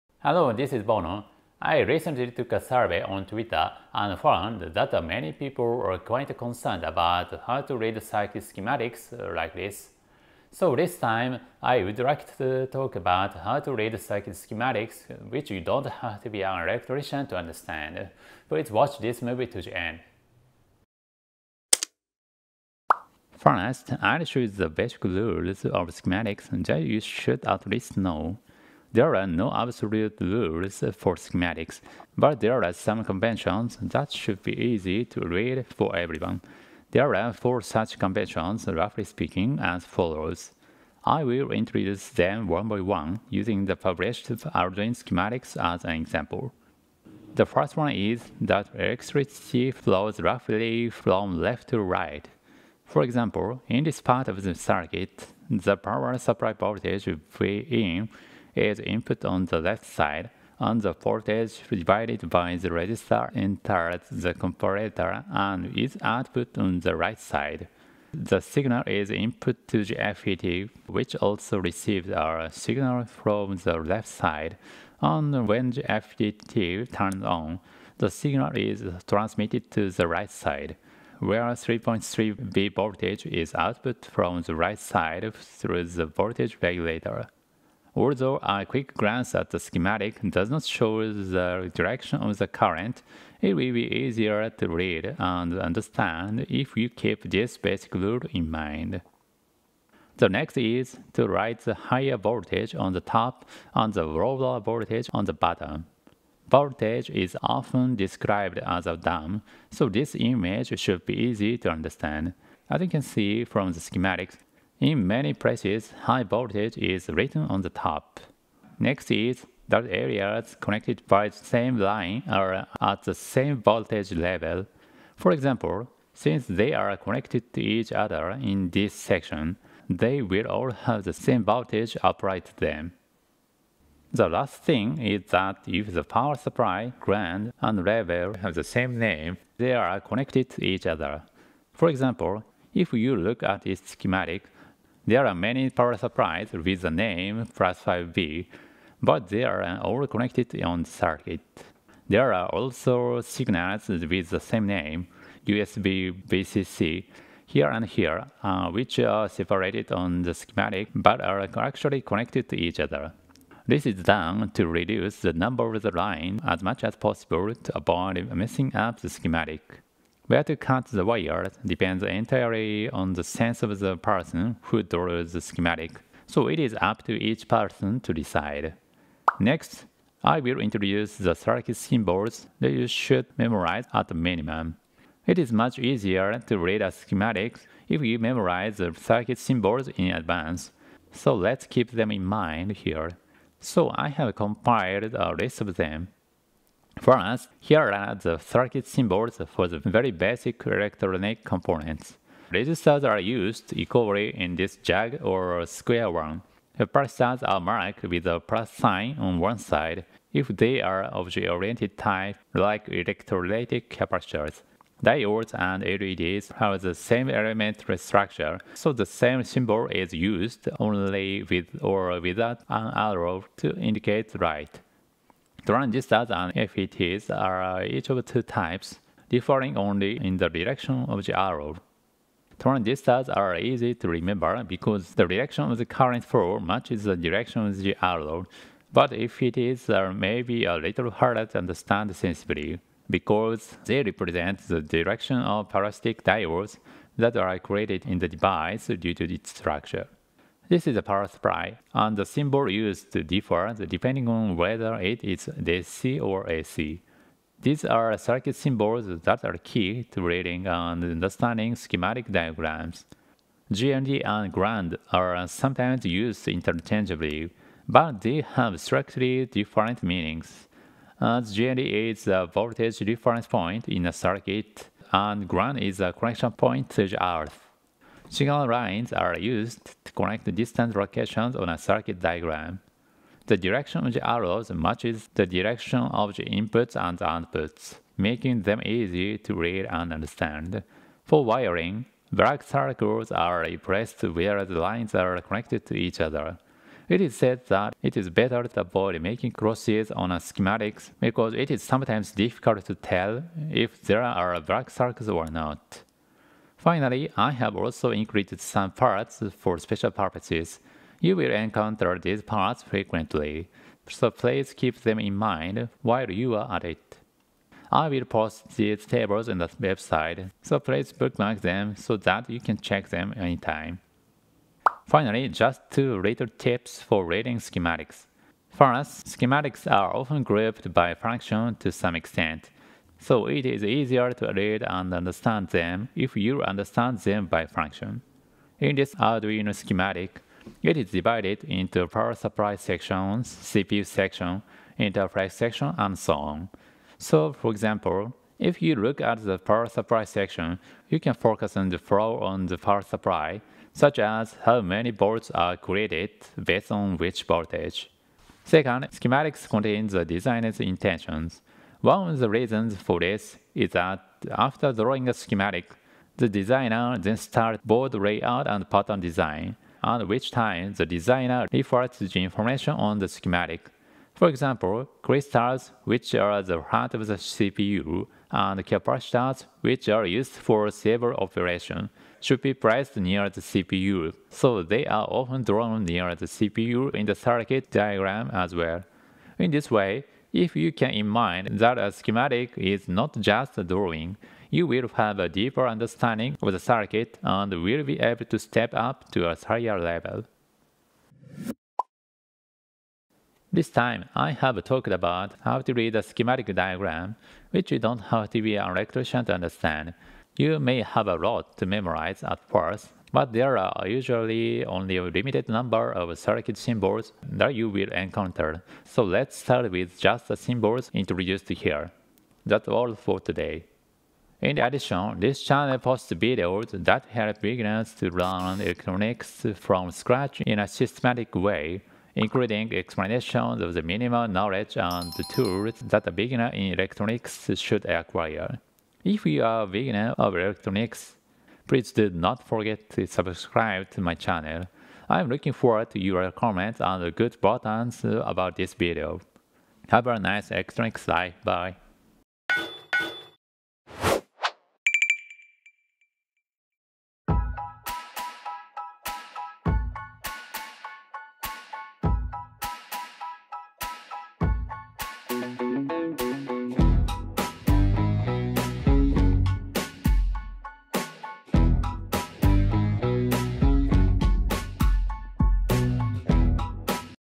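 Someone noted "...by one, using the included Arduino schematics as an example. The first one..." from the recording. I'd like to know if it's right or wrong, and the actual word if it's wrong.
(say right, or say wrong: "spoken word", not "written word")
wrong: "published", not "included".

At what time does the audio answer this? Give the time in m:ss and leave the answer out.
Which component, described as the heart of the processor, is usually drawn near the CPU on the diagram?
6:15.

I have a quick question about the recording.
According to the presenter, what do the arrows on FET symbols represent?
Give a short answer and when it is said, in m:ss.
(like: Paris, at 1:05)
parasitic diodes, at 4:05.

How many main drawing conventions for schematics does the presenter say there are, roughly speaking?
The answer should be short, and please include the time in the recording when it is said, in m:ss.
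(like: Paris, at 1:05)
4, at 0:37.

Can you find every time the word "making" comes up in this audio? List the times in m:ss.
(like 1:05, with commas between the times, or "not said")
4:48, 4:59.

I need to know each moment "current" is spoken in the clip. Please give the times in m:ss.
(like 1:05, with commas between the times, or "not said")
1:32, 3:55.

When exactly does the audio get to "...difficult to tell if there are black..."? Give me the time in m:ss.
5:02.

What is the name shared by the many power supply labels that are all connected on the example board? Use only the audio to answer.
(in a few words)
Plus5V.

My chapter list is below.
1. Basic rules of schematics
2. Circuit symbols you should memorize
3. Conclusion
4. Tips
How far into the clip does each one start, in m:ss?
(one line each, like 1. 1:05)
1. 0:23
2. 3:00
3. 6:43
4. 5:25.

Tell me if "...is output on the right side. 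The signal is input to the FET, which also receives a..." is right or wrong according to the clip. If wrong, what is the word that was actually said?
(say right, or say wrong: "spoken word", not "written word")
right.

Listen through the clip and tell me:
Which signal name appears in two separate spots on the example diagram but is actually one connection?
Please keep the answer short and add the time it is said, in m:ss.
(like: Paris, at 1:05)
USB VCC, at 2:35.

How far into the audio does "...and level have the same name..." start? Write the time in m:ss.
2:17.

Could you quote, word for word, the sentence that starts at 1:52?
As you can see from the schematics, in many places, high voltage is written on the top.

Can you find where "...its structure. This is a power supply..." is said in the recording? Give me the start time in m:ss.
4:09.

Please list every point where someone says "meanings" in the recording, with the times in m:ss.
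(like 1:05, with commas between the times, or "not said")
4:30.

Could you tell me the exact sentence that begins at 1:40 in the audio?
The next is to write the higher voltage on the top and the lower voltage on the bottom.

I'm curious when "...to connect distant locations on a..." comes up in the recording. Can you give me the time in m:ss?
4:40.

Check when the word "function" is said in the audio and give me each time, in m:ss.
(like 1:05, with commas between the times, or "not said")
5:31, 5:37.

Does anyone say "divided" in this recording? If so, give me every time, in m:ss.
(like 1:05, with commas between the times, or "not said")
1:01, 5:41.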